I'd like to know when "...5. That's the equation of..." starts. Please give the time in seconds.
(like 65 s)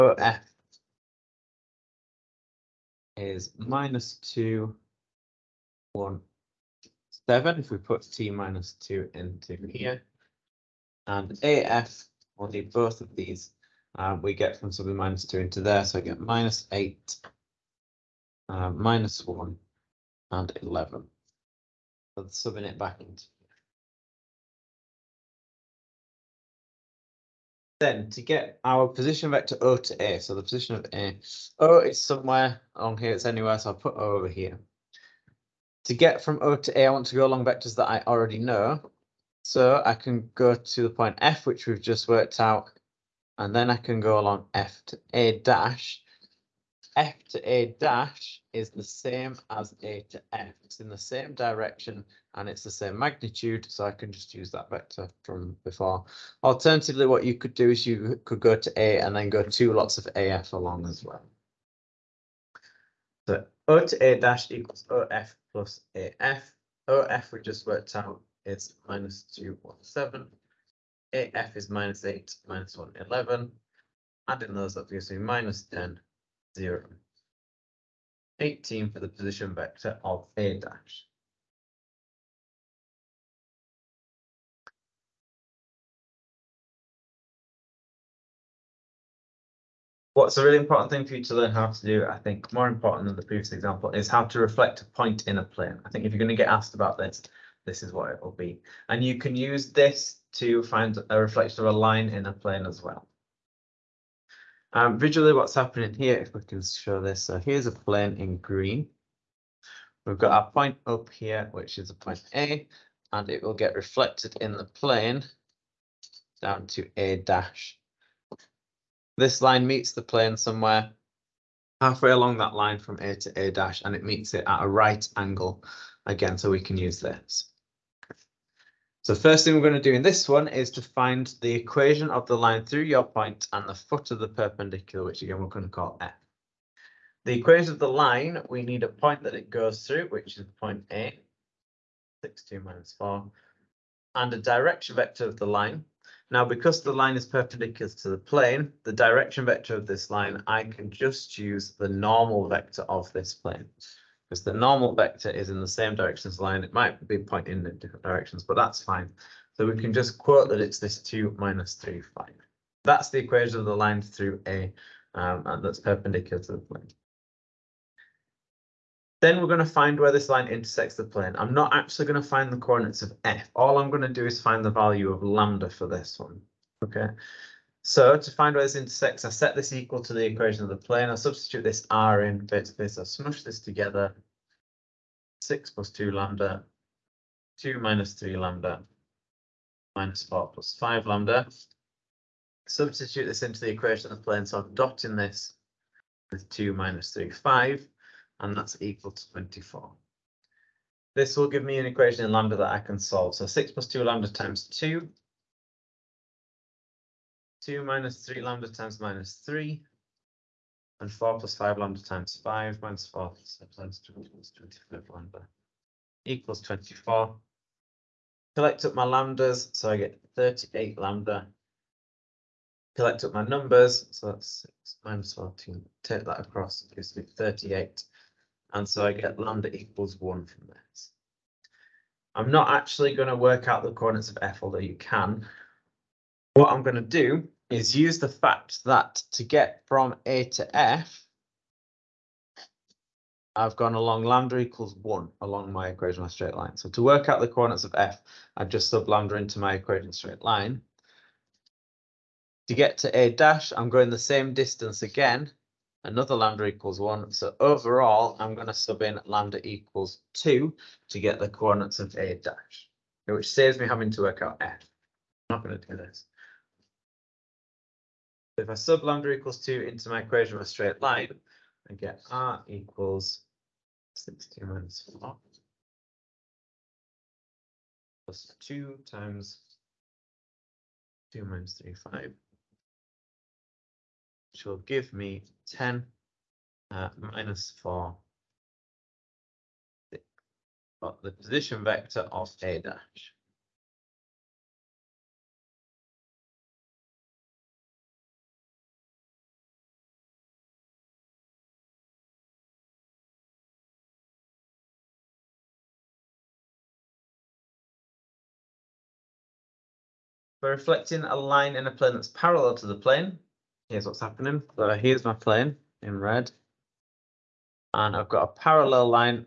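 162 s.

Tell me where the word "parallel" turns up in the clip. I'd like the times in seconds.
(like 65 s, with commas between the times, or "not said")
312 s, 318 s.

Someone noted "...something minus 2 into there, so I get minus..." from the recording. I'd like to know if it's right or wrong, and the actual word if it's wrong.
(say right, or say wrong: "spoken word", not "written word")
right.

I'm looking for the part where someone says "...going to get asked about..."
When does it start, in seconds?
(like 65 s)
96 s.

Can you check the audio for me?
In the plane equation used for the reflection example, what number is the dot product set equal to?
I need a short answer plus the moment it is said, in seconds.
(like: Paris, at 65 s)
24, at 198 s.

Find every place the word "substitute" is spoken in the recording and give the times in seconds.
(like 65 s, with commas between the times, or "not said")
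181 s, 192 s.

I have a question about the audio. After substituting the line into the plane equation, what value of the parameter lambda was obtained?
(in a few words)
1.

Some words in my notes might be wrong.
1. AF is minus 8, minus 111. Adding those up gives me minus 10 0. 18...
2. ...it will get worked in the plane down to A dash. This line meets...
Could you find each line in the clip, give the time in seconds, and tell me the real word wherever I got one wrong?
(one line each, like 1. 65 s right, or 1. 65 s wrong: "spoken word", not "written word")
1. 71 s right
2. 113 s wrong: "reflected", not "worked".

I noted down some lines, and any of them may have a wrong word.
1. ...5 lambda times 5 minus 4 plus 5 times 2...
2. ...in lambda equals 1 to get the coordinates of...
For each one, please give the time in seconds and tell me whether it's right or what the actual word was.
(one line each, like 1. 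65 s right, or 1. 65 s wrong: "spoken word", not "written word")
1. 211 s right
2. 259 s wrong: "2", not "1".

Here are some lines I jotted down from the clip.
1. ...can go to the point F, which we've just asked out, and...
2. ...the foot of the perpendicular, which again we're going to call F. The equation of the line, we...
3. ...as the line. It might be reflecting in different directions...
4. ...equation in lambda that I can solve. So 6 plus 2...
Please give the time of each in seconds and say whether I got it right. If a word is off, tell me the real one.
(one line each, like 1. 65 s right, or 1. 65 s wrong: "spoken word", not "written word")
1. 39 s wrong: "worked", not "asked"
2. 133 s right
3. 156 s wrong: "pointing", not "reflecting"
4. 201 s right.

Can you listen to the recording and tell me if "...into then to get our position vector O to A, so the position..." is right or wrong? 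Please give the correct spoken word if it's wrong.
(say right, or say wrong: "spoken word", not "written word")
right.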